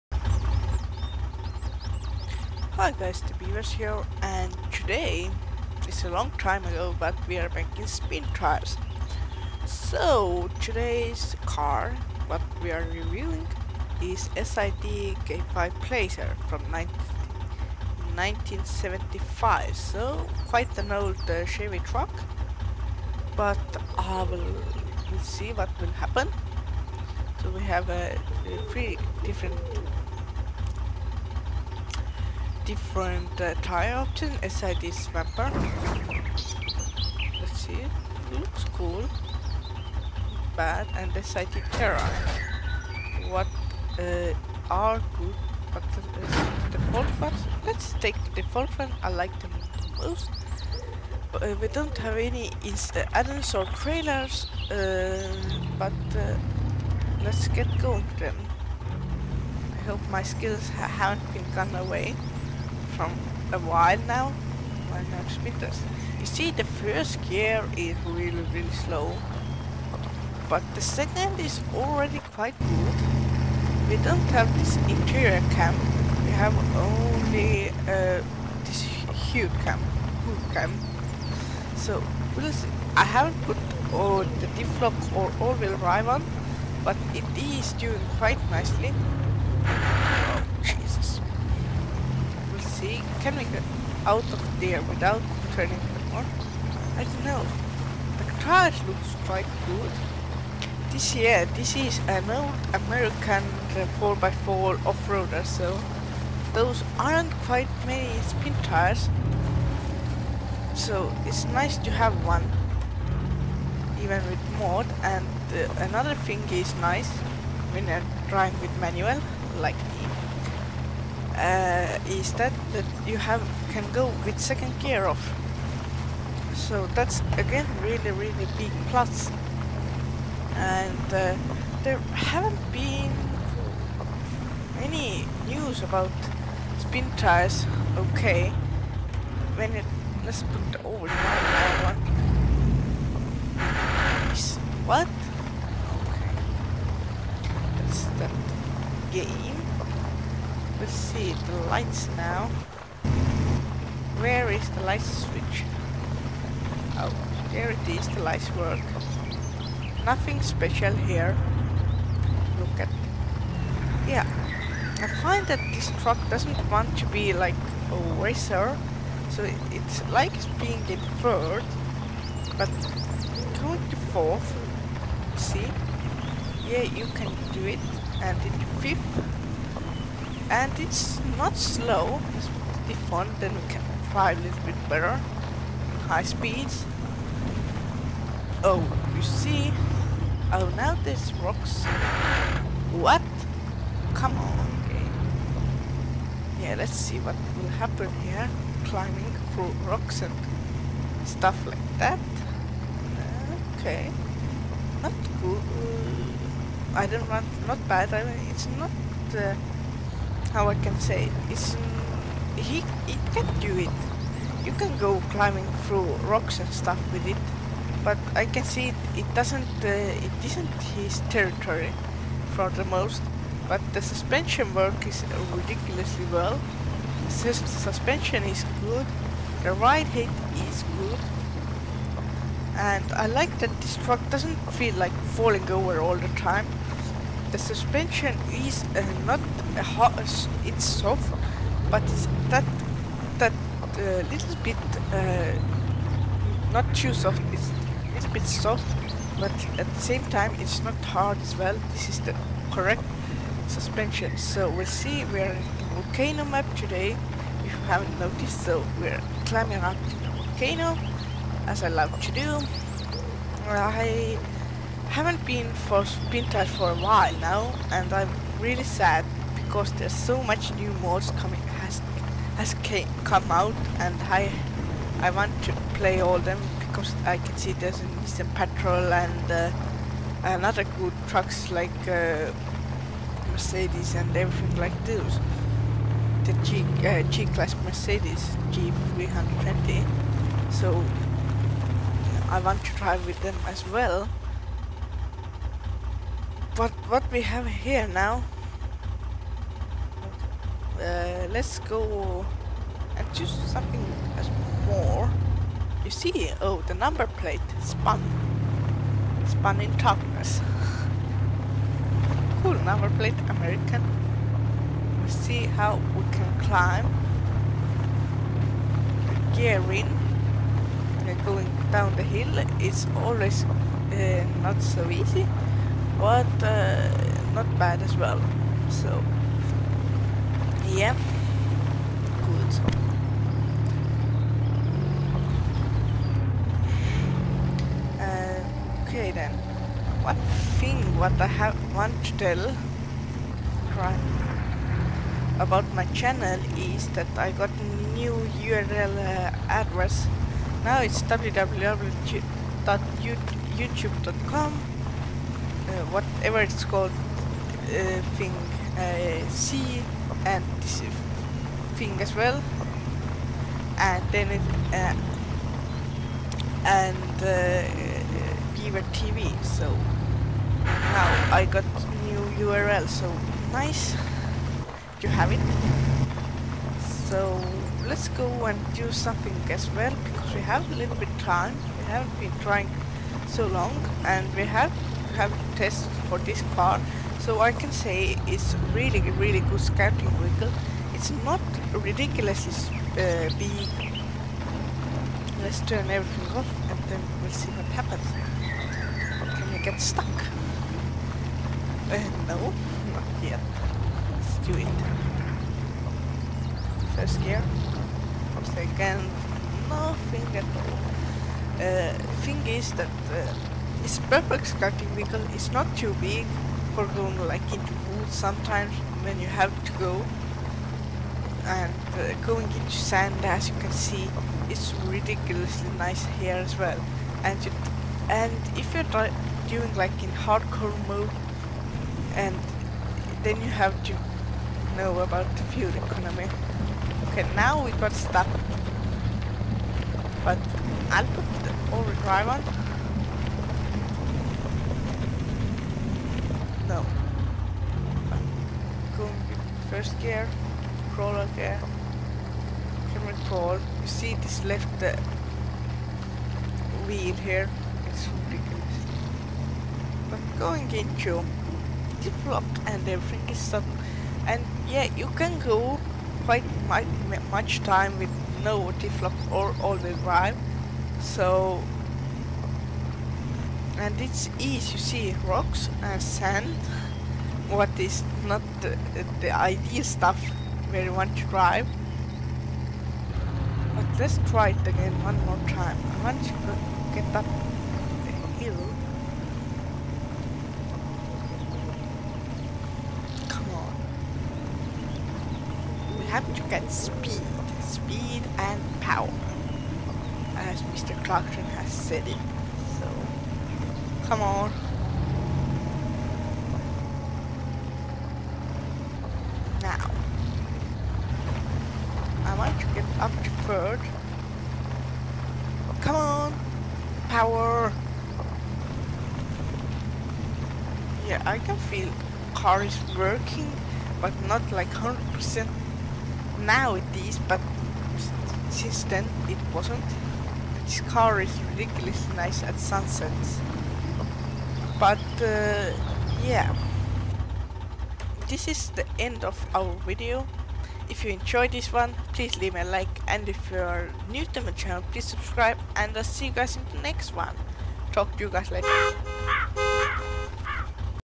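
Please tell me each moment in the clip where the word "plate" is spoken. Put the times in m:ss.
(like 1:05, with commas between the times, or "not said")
5:07, 5:13.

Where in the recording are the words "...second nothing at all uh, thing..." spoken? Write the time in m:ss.
6:48.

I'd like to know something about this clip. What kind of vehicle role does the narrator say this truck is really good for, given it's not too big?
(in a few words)
Scouting vehicle.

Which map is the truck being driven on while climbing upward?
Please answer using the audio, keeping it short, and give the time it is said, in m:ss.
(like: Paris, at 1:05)
Volcano map, at 4:16.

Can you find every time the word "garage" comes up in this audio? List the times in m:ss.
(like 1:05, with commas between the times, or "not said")
1:38.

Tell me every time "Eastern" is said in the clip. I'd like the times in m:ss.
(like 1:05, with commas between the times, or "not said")
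4:38.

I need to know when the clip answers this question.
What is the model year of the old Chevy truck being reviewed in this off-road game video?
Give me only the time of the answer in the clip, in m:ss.
0:18.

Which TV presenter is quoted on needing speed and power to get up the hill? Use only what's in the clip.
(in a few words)
Mr. Clarkson.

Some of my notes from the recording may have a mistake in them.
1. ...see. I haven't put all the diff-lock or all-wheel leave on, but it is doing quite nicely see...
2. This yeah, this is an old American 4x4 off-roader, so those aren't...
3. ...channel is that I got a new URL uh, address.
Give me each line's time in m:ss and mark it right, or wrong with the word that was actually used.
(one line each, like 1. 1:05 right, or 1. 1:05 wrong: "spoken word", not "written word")
1. 1:22 wrong: "drive", not "leave"
2. 1:40 right
3. 5:46 right.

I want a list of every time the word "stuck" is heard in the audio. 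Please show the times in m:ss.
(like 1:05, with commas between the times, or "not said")
6:40, 7:18.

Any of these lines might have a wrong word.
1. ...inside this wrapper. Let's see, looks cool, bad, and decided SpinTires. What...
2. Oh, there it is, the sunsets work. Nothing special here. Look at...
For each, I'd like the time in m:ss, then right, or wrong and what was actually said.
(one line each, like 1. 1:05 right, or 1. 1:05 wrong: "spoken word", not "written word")
1. 0:34 wrong: "Terra", not "SpinTires"
2. 2:36 wrong: "lights", not "sunsets".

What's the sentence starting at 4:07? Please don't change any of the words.
It's a little bit soft, but at the same time it's not hard as well.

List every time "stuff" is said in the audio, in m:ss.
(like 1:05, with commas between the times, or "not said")
3:21, 3:36, 8:00.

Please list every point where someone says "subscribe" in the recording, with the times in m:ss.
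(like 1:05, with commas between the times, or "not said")
9:05.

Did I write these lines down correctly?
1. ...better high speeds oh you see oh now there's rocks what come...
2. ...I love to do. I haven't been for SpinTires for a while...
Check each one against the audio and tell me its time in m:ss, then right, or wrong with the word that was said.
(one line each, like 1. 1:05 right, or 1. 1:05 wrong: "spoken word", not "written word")
1. 3:04 right
2. 4:21 right.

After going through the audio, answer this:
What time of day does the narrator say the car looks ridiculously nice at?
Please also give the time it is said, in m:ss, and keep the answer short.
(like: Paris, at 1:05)
Sunsets, at 8:52.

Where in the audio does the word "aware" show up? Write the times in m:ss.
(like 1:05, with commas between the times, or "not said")
not said.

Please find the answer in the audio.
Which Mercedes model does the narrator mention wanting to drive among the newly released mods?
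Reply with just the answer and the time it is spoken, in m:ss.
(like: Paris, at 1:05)
G320, at 4:48.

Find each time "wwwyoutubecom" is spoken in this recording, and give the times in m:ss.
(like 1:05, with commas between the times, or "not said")
5:51.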